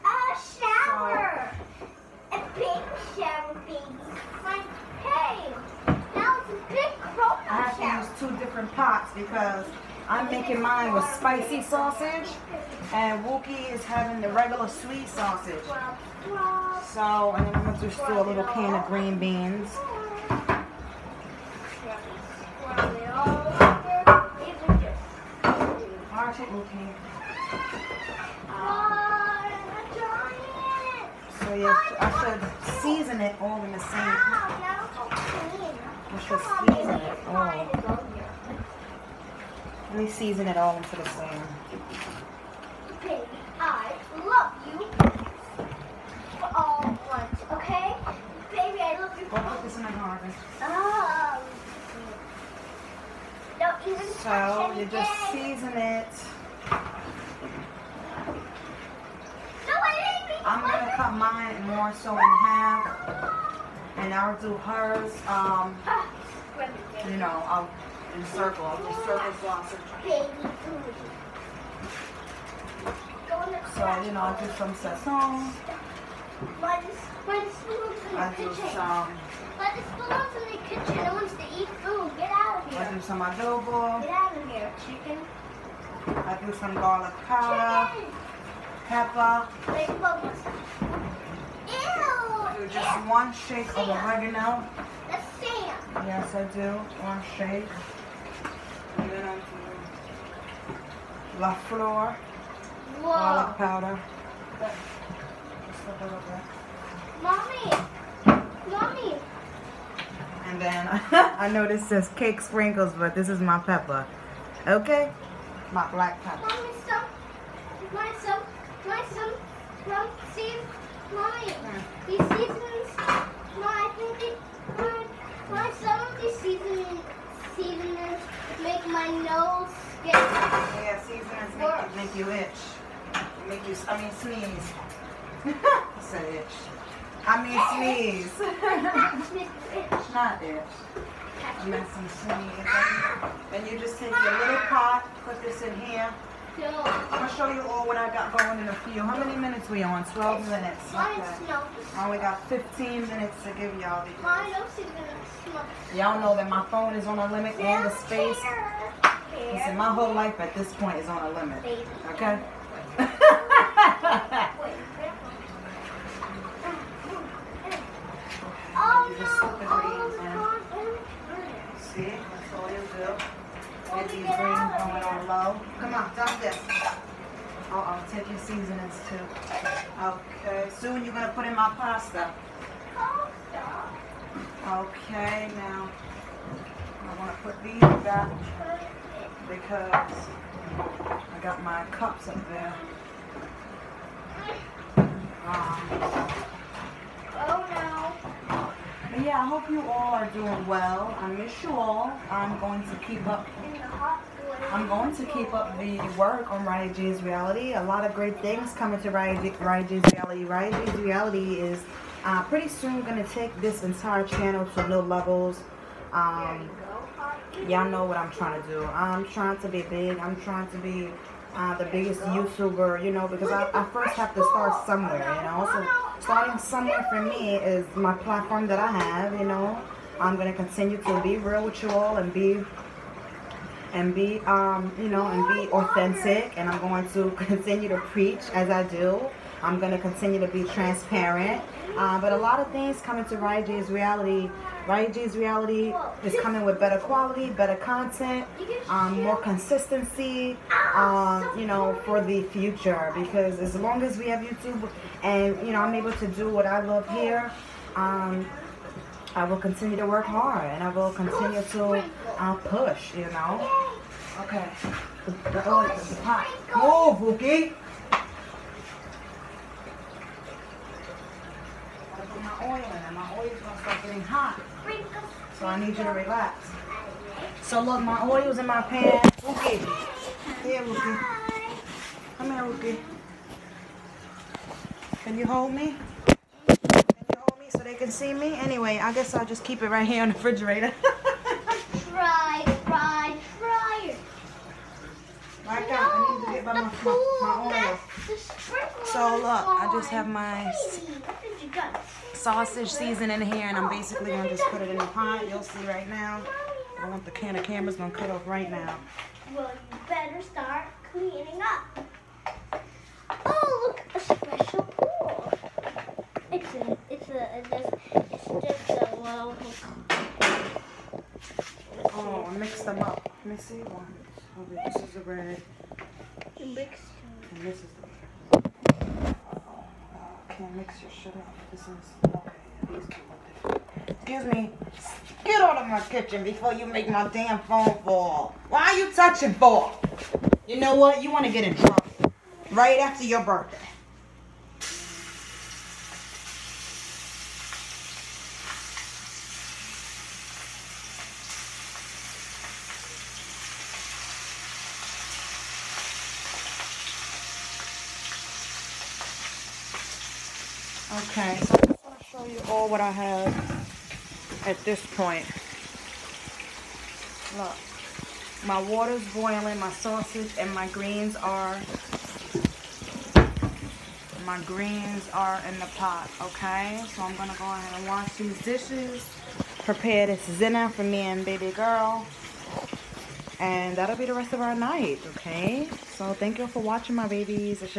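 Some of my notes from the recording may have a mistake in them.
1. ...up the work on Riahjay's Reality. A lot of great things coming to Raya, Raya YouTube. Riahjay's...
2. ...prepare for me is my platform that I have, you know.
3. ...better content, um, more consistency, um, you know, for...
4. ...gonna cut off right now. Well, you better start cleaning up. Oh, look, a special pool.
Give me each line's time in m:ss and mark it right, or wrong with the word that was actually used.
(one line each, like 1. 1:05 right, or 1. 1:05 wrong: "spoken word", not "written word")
1. 3:25 wrong: "Reality", not "YouTube"
2. 3:46 wrong: "somewhere", not "prepare"
3. 4:07 right
4. 5:07 right.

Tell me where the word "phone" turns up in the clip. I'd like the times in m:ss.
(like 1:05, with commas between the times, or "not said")
2:36, 5:37.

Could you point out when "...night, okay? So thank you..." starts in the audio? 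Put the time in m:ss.
6:24.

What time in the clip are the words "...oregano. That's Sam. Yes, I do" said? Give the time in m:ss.
1:33.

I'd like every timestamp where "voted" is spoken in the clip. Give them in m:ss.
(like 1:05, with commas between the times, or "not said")
not said.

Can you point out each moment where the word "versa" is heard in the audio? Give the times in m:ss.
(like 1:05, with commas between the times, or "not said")
not said.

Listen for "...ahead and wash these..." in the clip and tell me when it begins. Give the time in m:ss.
6:17.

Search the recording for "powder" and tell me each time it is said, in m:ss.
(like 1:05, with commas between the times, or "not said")
1:27, 1:43.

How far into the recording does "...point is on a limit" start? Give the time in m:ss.
2:40.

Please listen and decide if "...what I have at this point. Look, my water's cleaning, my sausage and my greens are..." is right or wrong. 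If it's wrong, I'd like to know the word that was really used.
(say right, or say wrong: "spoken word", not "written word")
wrong: "boiling", not "cleaning".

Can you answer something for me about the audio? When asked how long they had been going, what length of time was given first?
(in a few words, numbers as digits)
12 minutes.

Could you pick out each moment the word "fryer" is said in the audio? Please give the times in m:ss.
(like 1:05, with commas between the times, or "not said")
4:53.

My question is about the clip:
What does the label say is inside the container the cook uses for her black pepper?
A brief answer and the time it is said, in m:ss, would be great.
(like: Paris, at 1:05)
Cake sprinkles, at 1:52.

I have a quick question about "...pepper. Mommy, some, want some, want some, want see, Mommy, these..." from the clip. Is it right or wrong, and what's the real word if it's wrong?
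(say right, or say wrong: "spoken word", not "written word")
right.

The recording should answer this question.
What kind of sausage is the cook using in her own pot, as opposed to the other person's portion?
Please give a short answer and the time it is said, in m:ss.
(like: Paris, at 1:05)
Spicy sausage, at 0:11.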